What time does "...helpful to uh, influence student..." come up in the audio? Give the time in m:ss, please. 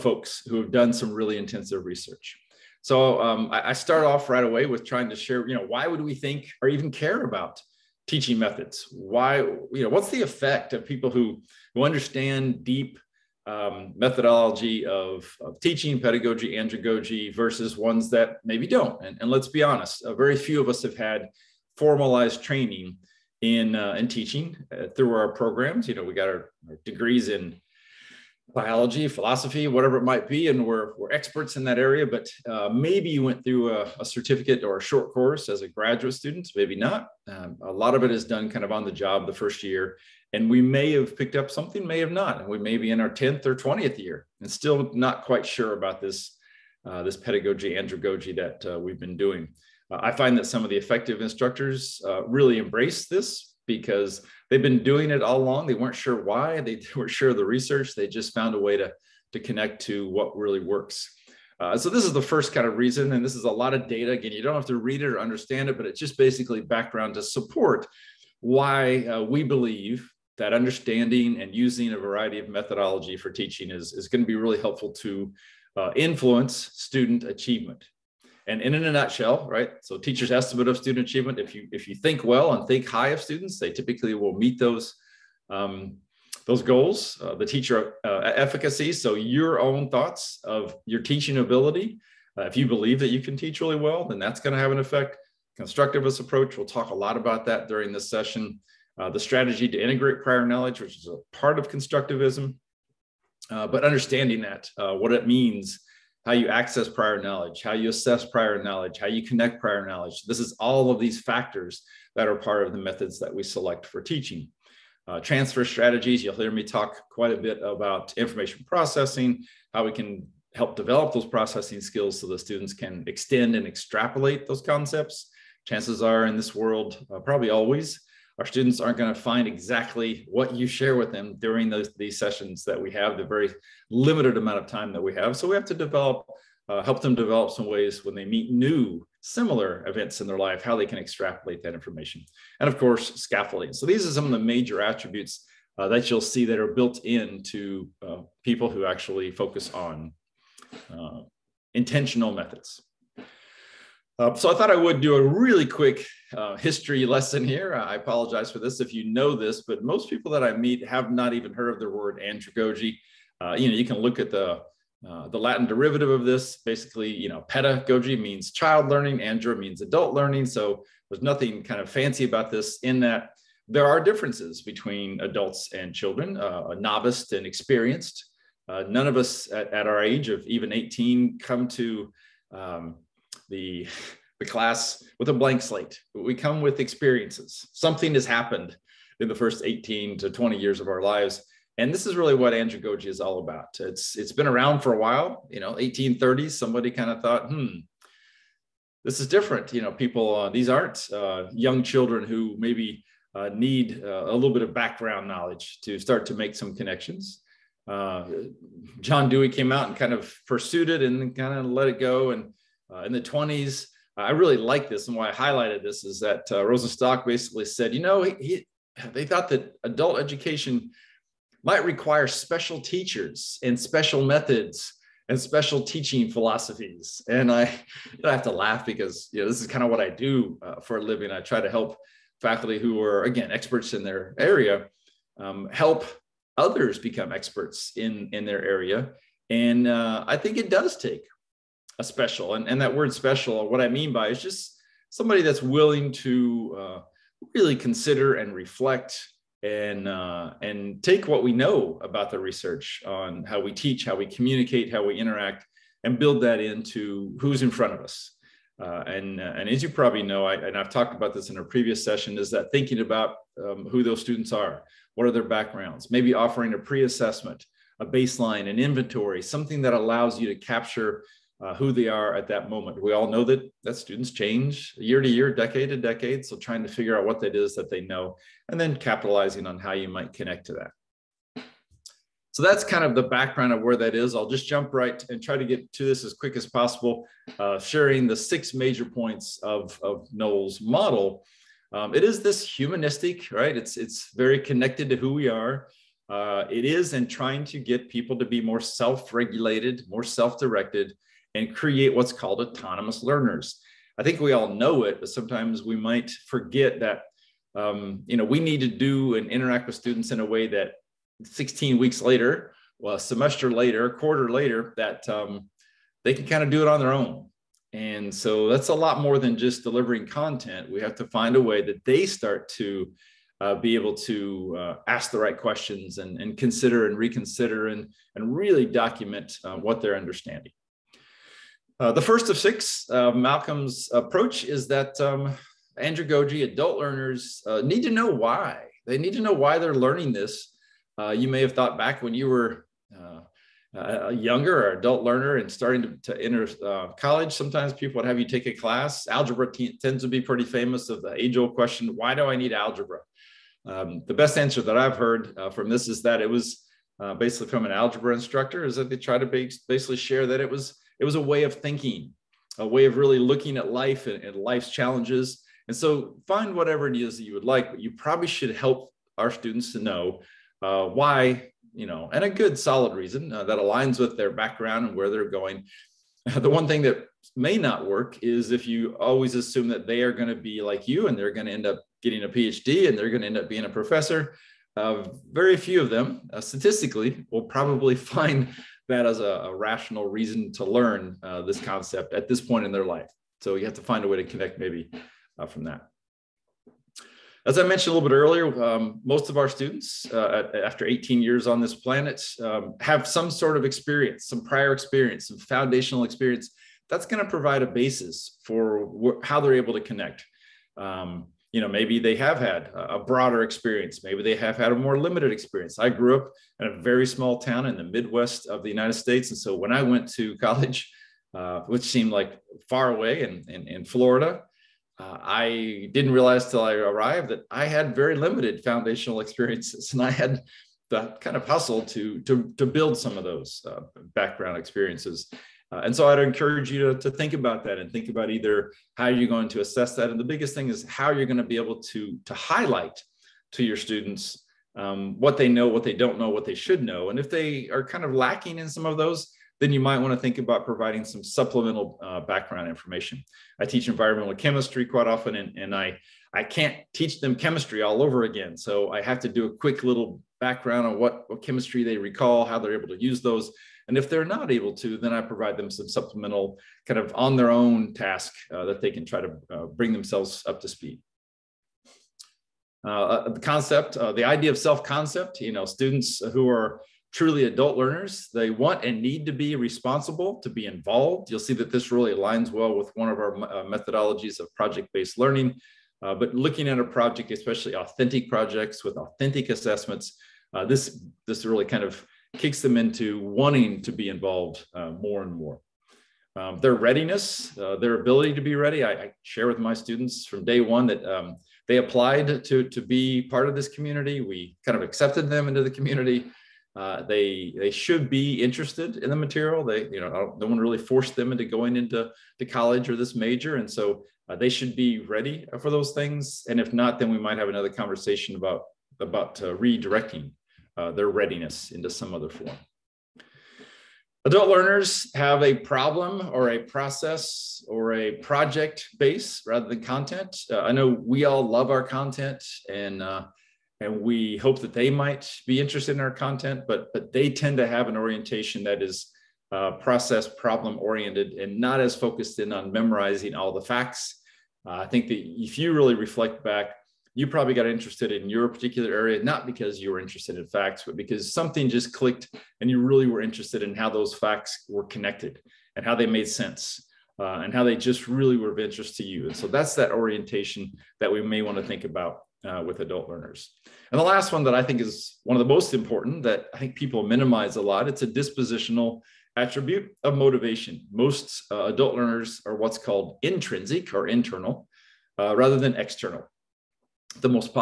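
1:14.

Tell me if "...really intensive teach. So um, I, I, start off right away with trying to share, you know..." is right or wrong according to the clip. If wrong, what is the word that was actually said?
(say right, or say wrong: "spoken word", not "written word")
wrong: "research", not "teach".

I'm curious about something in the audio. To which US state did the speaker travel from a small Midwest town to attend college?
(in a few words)
Florida.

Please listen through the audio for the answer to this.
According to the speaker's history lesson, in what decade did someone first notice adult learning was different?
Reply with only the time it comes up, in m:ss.
3:15.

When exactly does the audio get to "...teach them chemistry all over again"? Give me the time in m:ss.
7:37.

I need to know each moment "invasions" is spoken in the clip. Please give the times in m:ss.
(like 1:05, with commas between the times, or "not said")
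not said.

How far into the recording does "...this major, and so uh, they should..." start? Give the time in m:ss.
8:33.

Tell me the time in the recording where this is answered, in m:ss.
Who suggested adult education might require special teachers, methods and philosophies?
3:36.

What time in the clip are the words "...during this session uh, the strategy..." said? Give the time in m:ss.
1:37.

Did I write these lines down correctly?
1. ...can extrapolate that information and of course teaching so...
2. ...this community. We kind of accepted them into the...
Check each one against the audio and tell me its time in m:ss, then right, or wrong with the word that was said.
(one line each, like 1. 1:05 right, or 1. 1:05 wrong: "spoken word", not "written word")
1. 2:20 wrong: "scaffolding", not "teaching"
2. 8:23 right.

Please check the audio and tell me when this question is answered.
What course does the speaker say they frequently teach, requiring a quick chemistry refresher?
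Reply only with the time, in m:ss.
7:34.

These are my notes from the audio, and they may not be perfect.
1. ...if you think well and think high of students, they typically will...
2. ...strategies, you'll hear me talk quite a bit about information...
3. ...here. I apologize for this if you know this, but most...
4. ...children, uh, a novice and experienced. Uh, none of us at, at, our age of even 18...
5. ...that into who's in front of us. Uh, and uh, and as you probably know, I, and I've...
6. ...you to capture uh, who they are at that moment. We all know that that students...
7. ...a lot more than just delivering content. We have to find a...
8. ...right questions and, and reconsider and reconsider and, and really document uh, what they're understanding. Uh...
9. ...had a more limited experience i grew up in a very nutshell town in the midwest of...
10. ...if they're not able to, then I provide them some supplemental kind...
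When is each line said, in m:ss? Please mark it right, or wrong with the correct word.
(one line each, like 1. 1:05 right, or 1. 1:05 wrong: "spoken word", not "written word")
1. 1:21 right
2. 1:55 right
3. 2:37 right
4. 2:55 right
5. 4:16 right
6. 4:30 right
7. 5:18 right
8. 5:25 wrong: "consider", not "reconsider"
9. 6:54 wrong: "small", not "nutshell"
10. 7:44 right.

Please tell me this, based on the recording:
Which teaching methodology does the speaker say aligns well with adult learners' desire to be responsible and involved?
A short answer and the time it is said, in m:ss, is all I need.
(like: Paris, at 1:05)
Project-based learning, at 8:04.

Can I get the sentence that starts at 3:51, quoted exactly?
I try to help faculty who are again experts in their area um, help others become experts in in their area.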